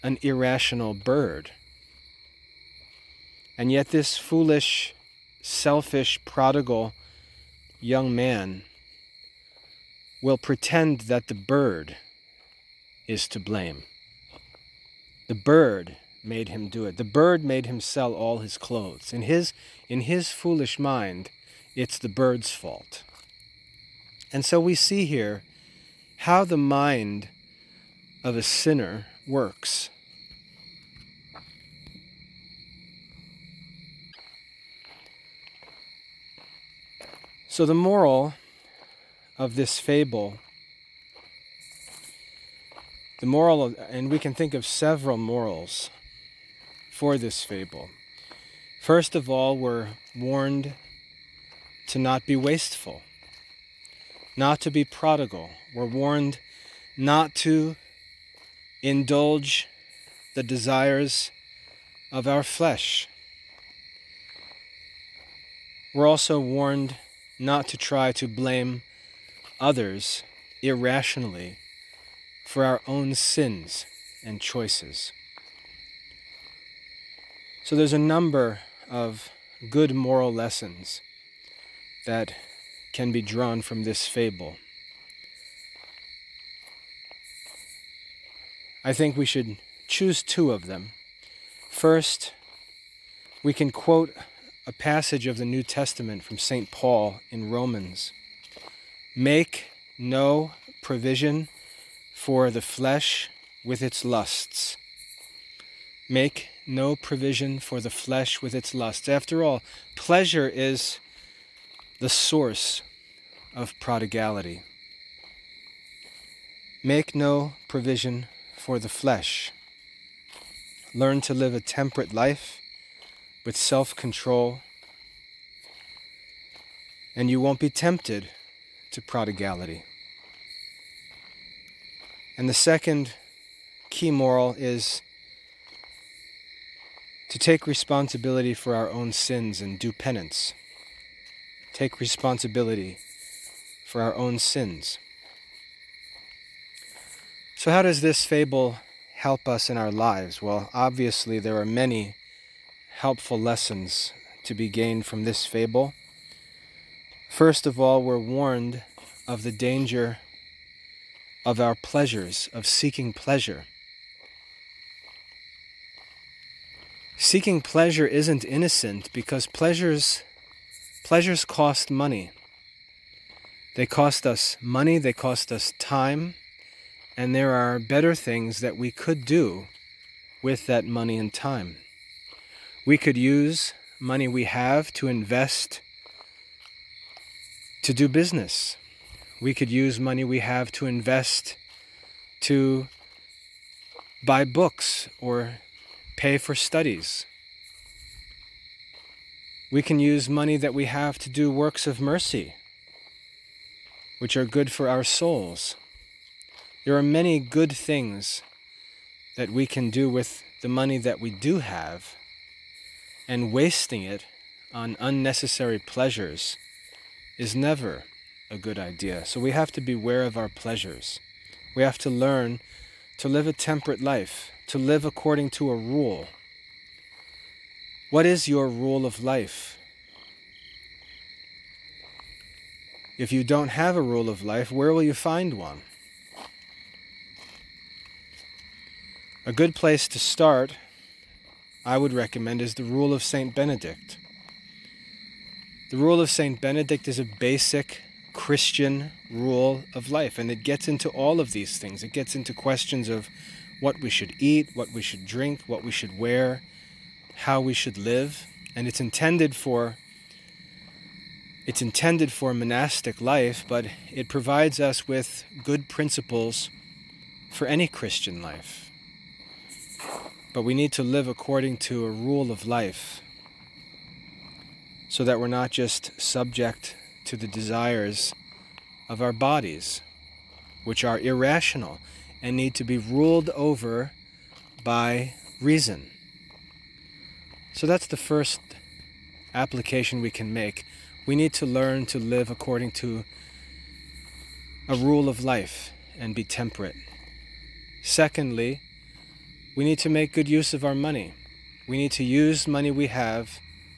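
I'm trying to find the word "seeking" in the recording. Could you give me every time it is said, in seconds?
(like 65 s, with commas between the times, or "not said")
162 s, 167 s.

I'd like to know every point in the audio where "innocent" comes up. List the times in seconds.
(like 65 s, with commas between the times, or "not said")
168 s.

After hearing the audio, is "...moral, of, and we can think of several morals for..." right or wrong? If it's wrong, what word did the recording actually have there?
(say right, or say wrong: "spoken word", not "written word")
right.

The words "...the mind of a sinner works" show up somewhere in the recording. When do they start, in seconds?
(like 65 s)
26 s.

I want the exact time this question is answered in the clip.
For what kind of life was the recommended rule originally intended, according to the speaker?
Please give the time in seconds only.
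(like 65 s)
262 s.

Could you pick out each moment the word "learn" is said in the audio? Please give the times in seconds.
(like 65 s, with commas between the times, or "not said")
120 s, 222 s, 291 s.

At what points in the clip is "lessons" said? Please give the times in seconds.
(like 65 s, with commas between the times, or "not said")
80 s, 153 s.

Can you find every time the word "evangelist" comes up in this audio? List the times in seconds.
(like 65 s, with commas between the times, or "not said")
not said.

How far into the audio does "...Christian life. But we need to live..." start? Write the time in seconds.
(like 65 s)
267 s.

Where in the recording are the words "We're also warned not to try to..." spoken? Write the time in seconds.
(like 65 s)
65 s.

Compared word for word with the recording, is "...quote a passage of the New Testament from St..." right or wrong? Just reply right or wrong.
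right.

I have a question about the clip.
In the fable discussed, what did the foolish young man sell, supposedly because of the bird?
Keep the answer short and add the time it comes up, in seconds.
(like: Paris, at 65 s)
All his clothes, at 18 s.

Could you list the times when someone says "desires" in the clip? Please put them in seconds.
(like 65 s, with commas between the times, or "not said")
60 s, 277 s.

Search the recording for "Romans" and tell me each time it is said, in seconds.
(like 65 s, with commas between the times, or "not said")
97 s.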